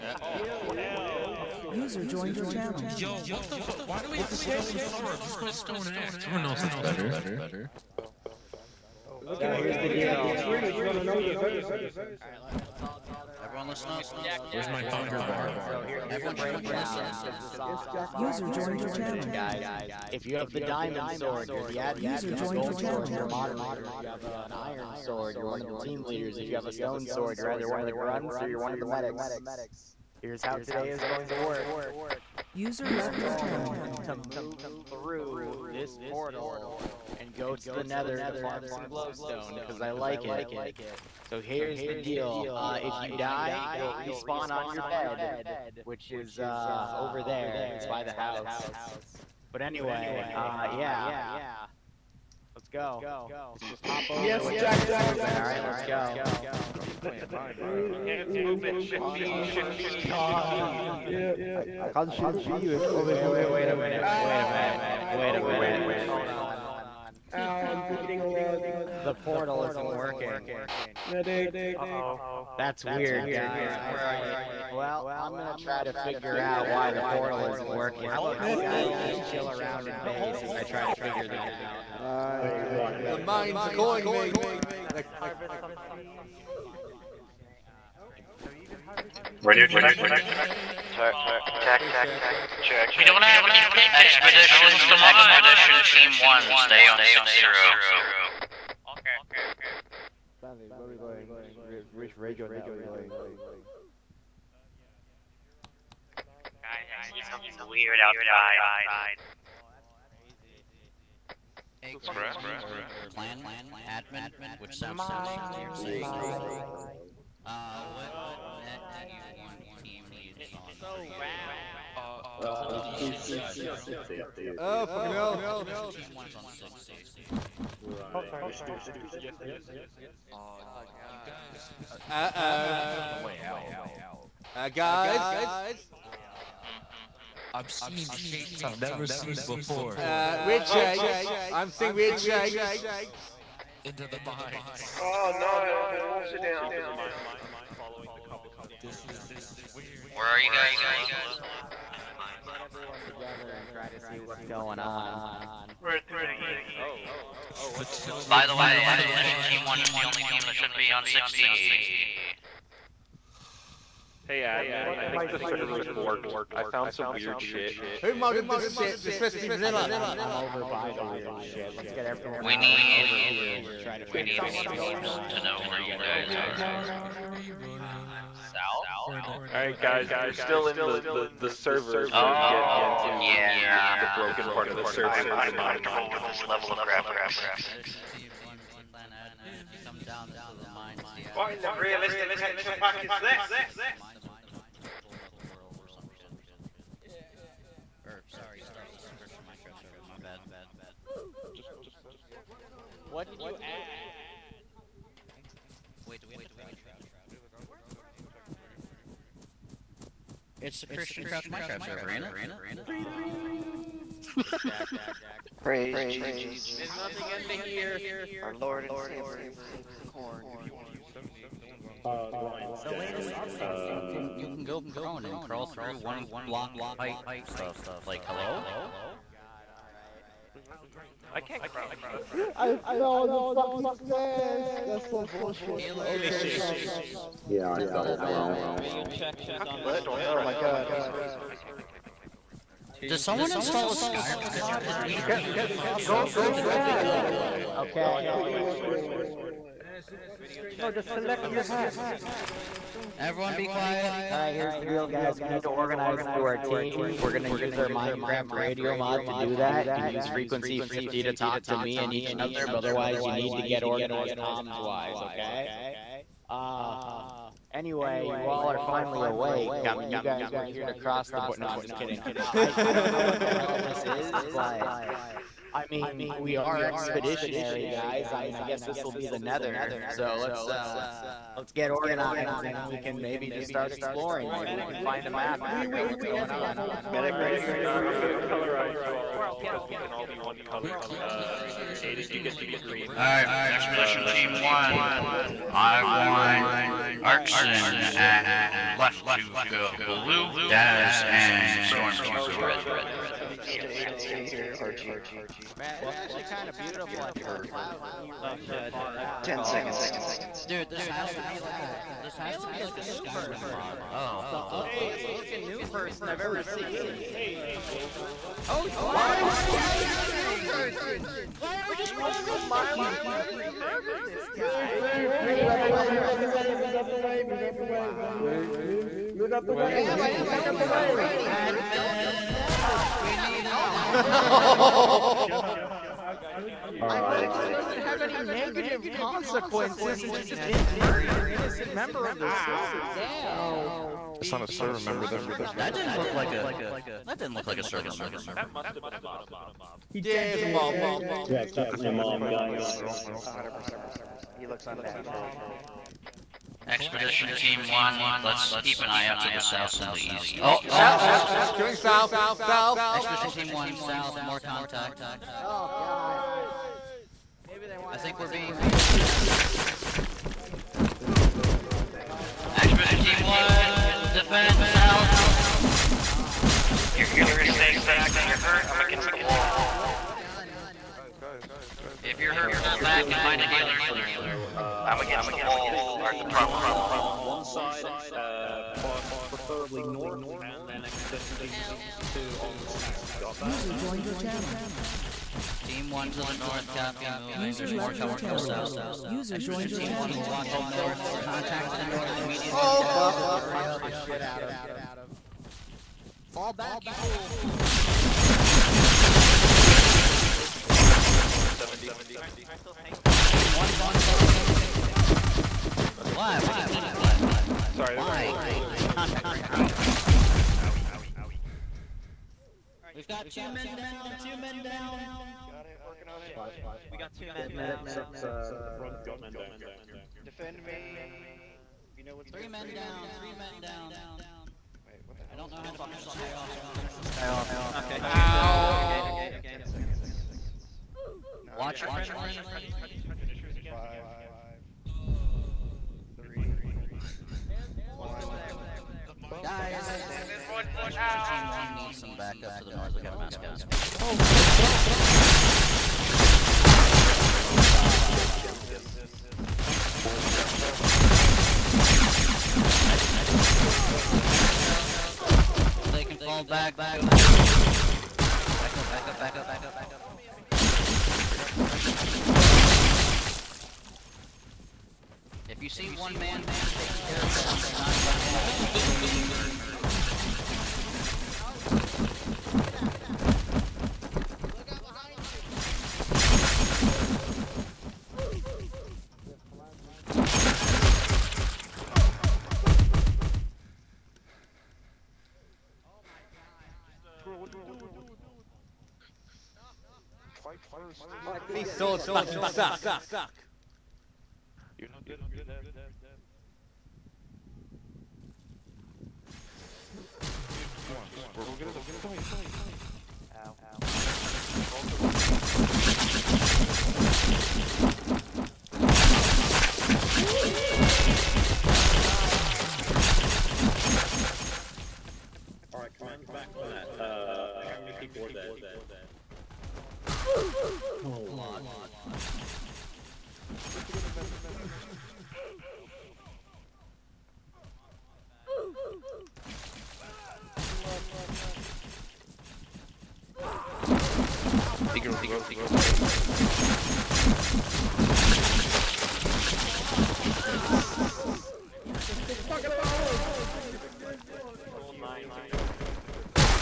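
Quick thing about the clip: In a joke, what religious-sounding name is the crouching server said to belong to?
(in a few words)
Christian Crouch.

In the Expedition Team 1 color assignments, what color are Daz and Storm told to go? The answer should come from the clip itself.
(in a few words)
Red.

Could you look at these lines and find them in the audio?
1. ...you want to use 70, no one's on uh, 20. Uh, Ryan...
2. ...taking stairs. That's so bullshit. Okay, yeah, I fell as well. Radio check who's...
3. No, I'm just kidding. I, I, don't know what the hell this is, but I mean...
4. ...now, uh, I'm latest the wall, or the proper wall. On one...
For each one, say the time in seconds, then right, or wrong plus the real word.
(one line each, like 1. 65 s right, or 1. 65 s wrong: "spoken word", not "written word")
1. 220 s wrong: "70", not "20"
2. 233 s wrong: "fucking", not "taking"
3. 271 s right
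4. 384 s wrong: "against", not "latest".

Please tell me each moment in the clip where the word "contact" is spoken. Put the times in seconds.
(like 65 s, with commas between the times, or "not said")
364 s, 401 s, 419 s.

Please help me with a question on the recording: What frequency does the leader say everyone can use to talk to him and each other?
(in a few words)
50.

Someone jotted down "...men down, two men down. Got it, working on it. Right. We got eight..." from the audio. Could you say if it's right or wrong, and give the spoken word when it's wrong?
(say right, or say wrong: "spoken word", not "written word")
wrong: "two", not "eight".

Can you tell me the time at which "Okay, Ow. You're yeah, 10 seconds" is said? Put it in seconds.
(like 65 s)
437 s.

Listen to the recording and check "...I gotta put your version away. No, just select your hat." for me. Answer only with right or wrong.
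wrong.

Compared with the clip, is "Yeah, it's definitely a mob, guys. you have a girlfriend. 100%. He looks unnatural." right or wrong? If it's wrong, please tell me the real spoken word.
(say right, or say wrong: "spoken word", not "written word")
right.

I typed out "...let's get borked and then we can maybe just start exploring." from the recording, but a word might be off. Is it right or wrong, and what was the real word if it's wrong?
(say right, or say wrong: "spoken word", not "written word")
wrong: "organized", not "borked".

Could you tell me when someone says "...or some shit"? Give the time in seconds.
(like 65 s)
195 s.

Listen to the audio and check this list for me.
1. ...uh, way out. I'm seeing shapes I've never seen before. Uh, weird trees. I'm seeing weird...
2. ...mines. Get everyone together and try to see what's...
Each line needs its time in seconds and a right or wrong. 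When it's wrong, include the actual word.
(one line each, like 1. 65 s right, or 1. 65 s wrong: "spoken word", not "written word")
1. 136 s wrong: "shapes", not "trees"
2. 152 s right.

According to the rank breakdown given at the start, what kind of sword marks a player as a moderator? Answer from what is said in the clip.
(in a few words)
Gold sword.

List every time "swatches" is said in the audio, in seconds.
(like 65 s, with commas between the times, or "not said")
not said.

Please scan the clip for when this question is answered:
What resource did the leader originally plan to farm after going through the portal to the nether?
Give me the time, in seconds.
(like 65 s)
38 s.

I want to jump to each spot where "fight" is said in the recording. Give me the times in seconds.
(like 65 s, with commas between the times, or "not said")
512 s.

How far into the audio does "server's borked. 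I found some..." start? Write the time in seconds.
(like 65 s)
165 s.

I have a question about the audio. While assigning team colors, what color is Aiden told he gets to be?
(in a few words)
Green.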